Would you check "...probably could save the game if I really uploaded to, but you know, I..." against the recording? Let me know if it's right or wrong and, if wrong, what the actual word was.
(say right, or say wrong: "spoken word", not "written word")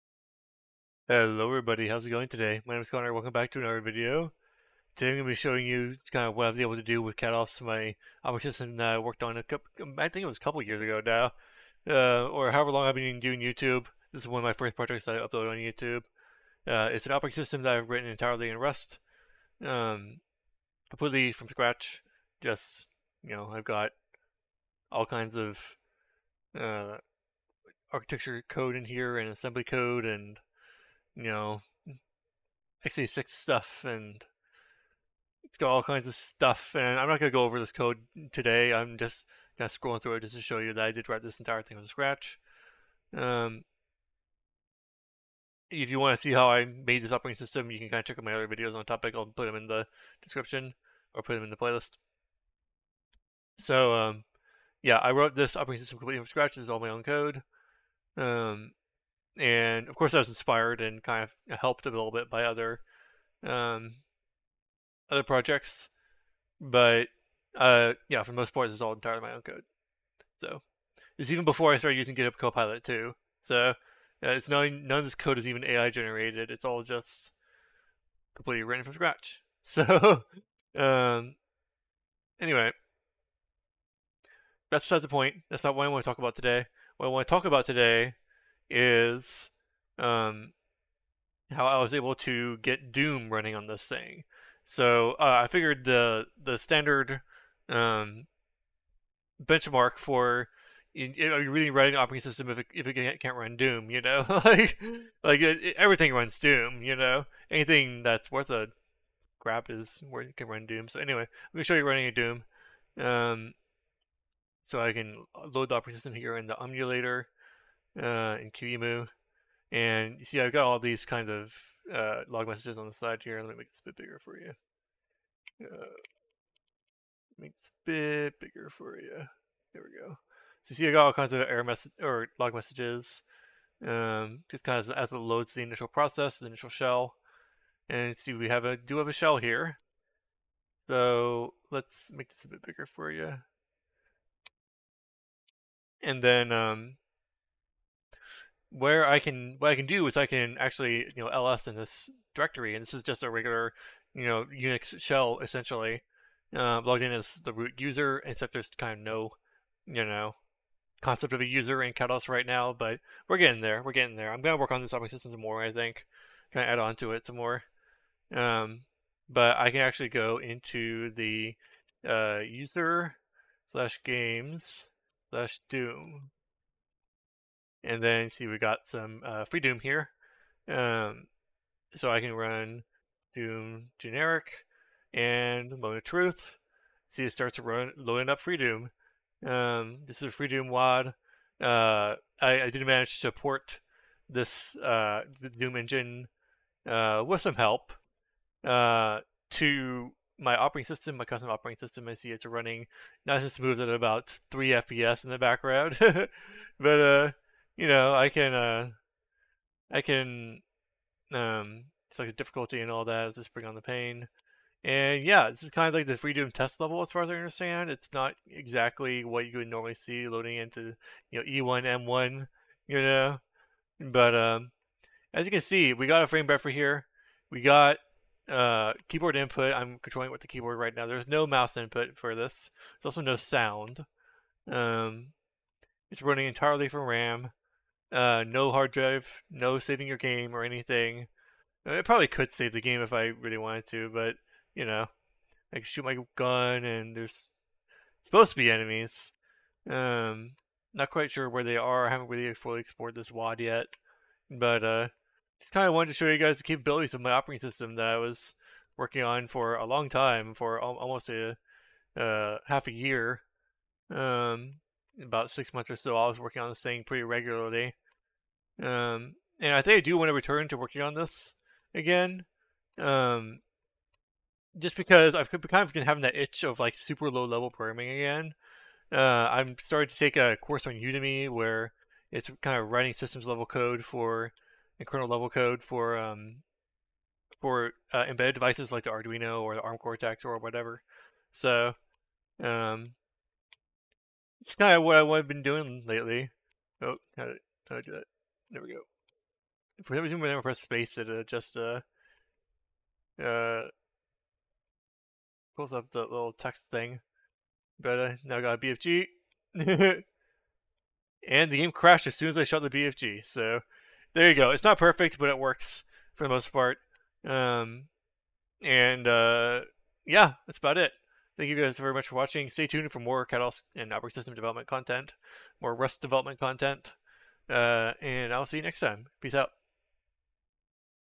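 wrong: "wanted", not "uploaded".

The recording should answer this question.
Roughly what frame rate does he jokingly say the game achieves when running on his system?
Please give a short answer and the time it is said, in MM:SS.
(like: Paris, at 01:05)
3 FPS, at 03:24.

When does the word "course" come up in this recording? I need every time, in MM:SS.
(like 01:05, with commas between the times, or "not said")
00:59, 04:40.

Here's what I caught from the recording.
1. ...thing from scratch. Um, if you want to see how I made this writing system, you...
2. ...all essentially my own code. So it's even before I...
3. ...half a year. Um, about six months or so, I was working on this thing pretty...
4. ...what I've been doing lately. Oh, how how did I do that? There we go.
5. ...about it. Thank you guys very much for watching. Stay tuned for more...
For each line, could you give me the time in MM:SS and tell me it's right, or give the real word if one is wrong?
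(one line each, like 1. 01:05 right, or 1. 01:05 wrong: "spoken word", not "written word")
1. 00:41 wrong: "operating", not "writing"
2. 01:08 wrong: "entirely", not "essentially"
3. 04:22 right
4. 04:55 right
5. 05:20 right.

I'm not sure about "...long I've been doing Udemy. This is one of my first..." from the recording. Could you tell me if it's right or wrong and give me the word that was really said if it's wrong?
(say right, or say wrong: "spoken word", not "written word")
wrong: "YouTube", not "Udemy".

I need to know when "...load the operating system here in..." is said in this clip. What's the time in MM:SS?
01:55.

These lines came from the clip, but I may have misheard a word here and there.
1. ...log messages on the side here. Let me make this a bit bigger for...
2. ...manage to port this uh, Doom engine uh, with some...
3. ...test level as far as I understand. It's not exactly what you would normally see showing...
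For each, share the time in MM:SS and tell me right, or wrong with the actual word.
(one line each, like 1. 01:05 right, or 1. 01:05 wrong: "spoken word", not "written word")
1. 02:02 right
2. 03:12 right
3. 03:36 wrong: "loading", not "showing".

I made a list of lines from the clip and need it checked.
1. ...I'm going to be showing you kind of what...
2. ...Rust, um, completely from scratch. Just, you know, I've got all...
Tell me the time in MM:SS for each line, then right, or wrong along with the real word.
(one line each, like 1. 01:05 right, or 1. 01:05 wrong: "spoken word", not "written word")
1. 00:05 right
2. 00:18 right.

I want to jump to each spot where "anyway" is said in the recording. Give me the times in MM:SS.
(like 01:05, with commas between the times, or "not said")
01:22, 01:51.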